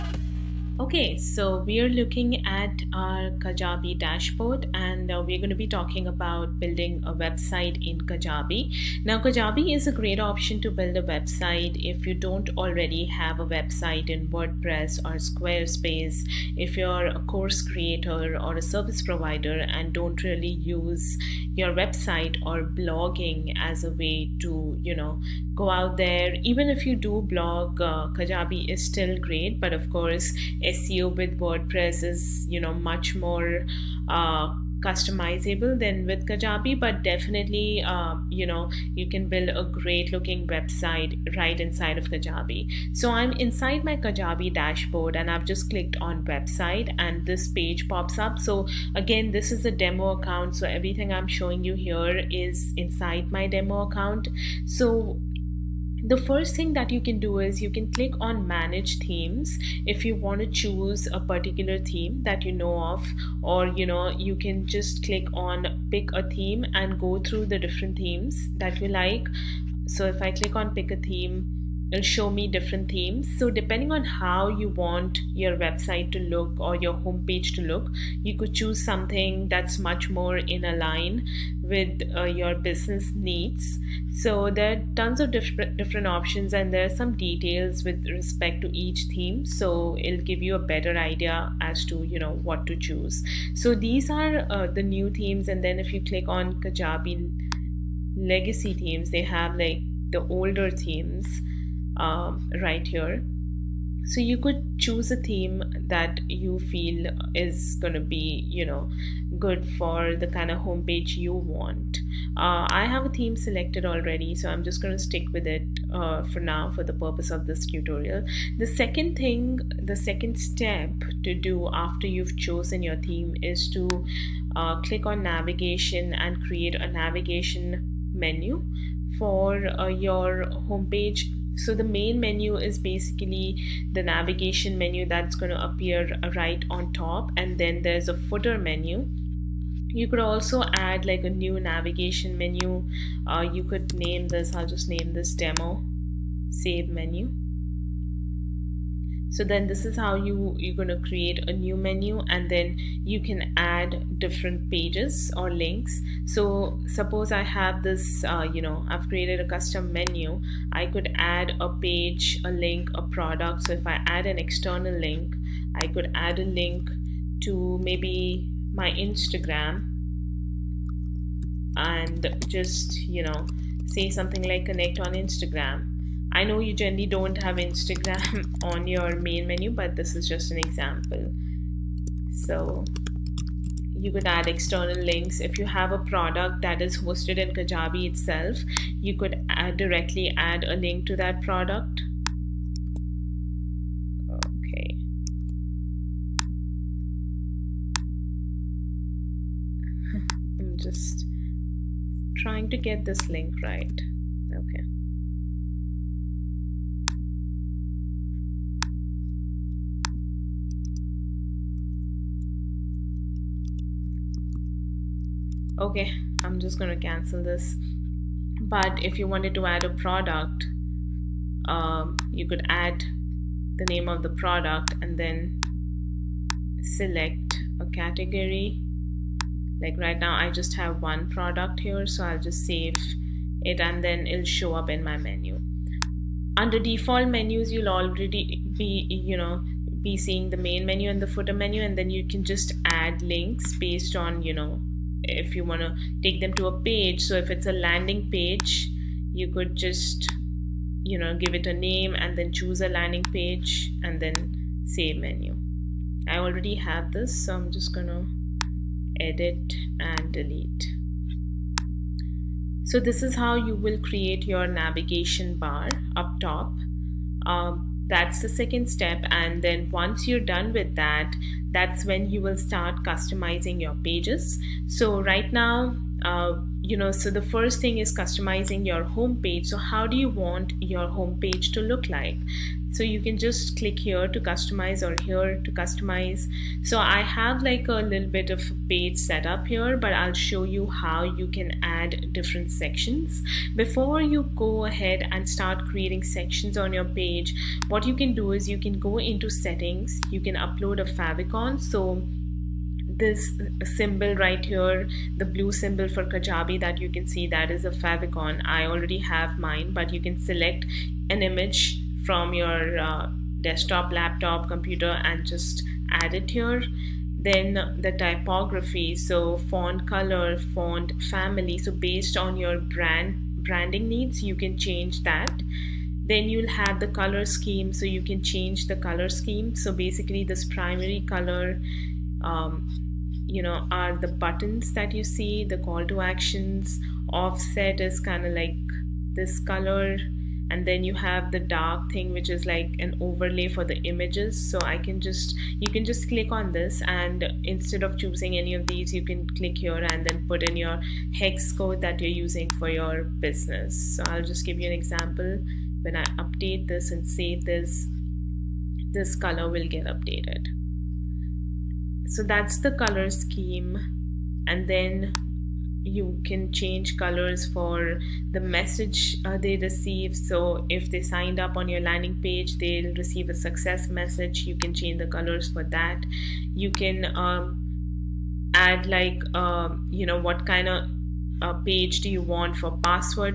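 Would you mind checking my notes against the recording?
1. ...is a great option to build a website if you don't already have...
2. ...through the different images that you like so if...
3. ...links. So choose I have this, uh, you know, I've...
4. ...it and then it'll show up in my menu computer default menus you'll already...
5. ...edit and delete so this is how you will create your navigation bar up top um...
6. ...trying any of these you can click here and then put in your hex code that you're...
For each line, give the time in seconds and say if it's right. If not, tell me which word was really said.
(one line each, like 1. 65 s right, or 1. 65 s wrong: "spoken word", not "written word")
1. 9 s right
2. 67 s wrong: "themes", not "images"
3. 155 s wrong: "suppose", not "choose"
4. 233 s wrong: "under", not "computer"
5. 259 s right
6. 348 s wrong: "choosing", not "trying".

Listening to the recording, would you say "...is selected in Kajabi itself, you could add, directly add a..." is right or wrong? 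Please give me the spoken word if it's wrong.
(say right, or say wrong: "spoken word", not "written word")
wrong: "hosted", not "selected".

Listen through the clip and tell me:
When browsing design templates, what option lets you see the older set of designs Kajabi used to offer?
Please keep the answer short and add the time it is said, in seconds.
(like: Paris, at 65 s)
Kajabi legacy themes, at 96 s.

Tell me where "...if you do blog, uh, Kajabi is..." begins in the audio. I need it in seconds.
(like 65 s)
26 s.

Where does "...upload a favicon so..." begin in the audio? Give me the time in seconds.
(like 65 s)
300 s.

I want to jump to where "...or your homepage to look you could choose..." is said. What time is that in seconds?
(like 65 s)
76 s.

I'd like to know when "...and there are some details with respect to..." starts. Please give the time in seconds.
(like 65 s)
86 s.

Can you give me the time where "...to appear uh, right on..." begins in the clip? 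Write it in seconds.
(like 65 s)
135 s.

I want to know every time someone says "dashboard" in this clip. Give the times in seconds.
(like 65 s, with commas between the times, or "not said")
3 s, 44 s.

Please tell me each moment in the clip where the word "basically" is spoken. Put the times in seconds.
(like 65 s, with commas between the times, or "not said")
132 s, 329 s.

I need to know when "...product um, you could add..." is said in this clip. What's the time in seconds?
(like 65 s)
219 s.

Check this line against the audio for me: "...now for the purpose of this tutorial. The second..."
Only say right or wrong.
right.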